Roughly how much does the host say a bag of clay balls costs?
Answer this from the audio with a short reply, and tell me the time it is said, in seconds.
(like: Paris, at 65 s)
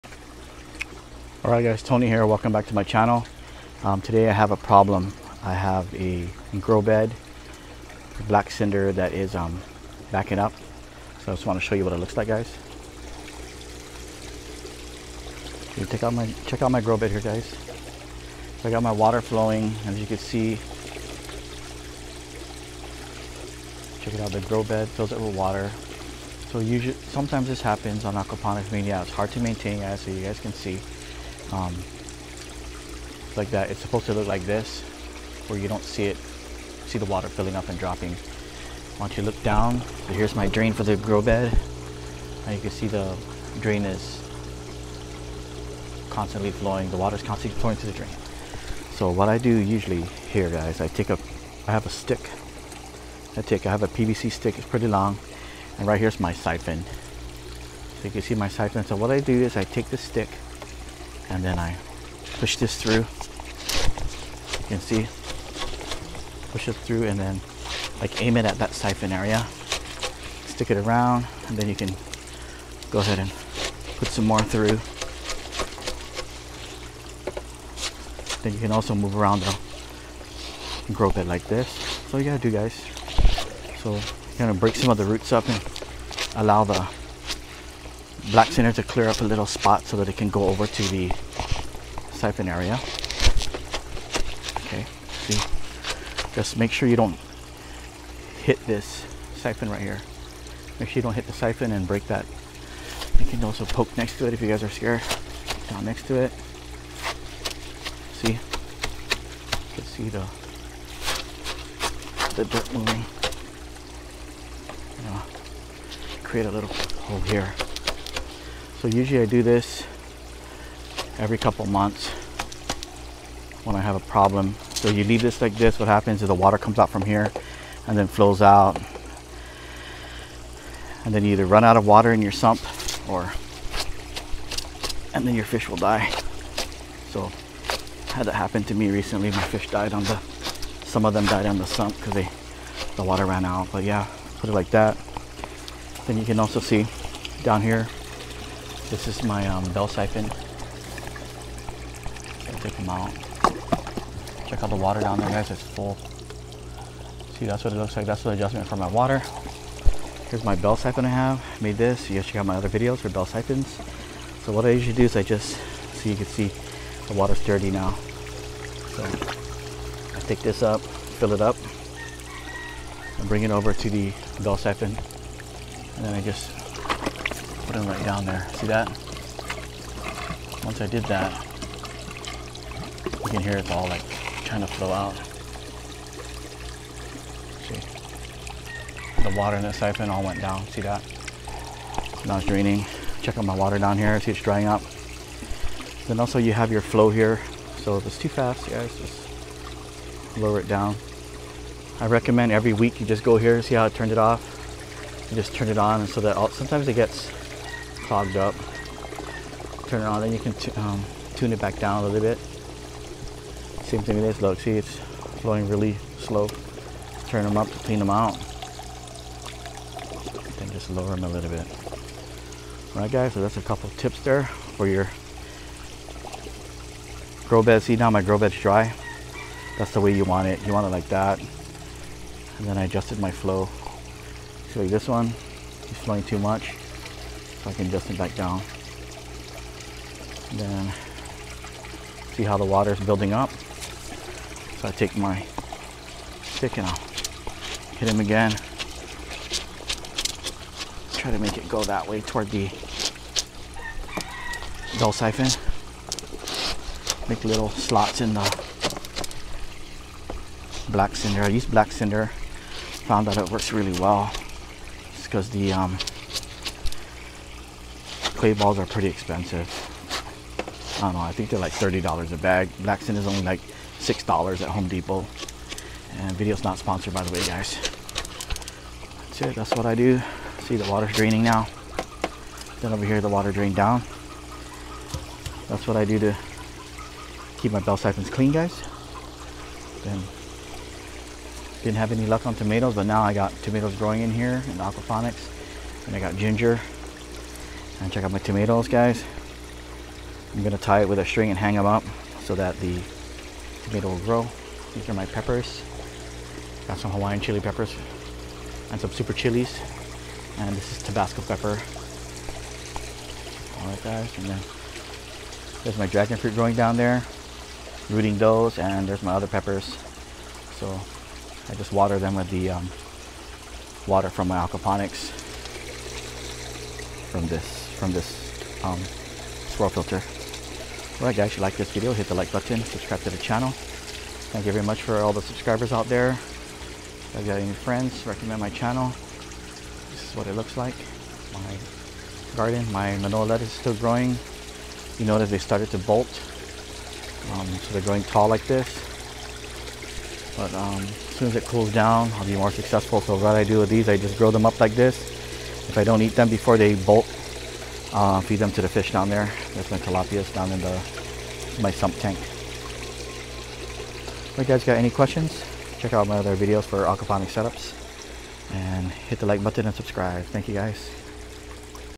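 $30, at 271 s.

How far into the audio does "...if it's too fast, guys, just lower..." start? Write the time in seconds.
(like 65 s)
197 s.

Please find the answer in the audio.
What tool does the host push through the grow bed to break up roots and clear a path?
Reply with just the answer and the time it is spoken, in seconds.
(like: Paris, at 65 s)
PVC stick, at 53 s.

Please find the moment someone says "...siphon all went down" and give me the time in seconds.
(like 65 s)
189 s.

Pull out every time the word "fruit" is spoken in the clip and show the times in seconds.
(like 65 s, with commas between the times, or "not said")
316 s.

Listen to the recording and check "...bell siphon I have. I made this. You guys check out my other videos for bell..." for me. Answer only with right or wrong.
right.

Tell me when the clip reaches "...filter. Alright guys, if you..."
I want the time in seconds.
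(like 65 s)
329 s.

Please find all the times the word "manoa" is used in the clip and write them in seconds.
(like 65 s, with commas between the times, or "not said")
343 s.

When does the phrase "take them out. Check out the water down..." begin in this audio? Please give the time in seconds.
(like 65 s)
152 s.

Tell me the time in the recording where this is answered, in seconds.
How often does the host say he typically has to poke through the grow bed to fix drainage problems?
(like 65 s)
121 s.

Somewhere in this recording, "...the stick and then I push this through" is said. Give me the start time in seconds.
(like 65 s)
59 s.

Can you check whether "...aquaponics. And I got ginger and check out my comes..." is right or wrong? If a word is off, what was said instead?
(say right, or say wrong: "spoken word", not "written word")
wrong: "tomatoes", not "comes".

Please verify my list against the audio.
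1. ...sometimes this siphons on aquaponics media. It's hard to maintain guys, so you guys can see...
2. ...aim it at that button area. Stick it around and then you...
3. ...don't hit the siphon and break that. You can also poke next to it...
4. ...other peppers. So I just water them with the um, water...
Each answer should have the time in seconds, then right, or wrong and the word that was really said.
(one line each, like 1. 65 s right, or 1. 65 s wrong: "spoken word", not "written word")
1. 26 s wrong: "happens", not "siphons"
2. 68 s wrong: "siphon", not "button"
3. 101 s right
4. 319 s right.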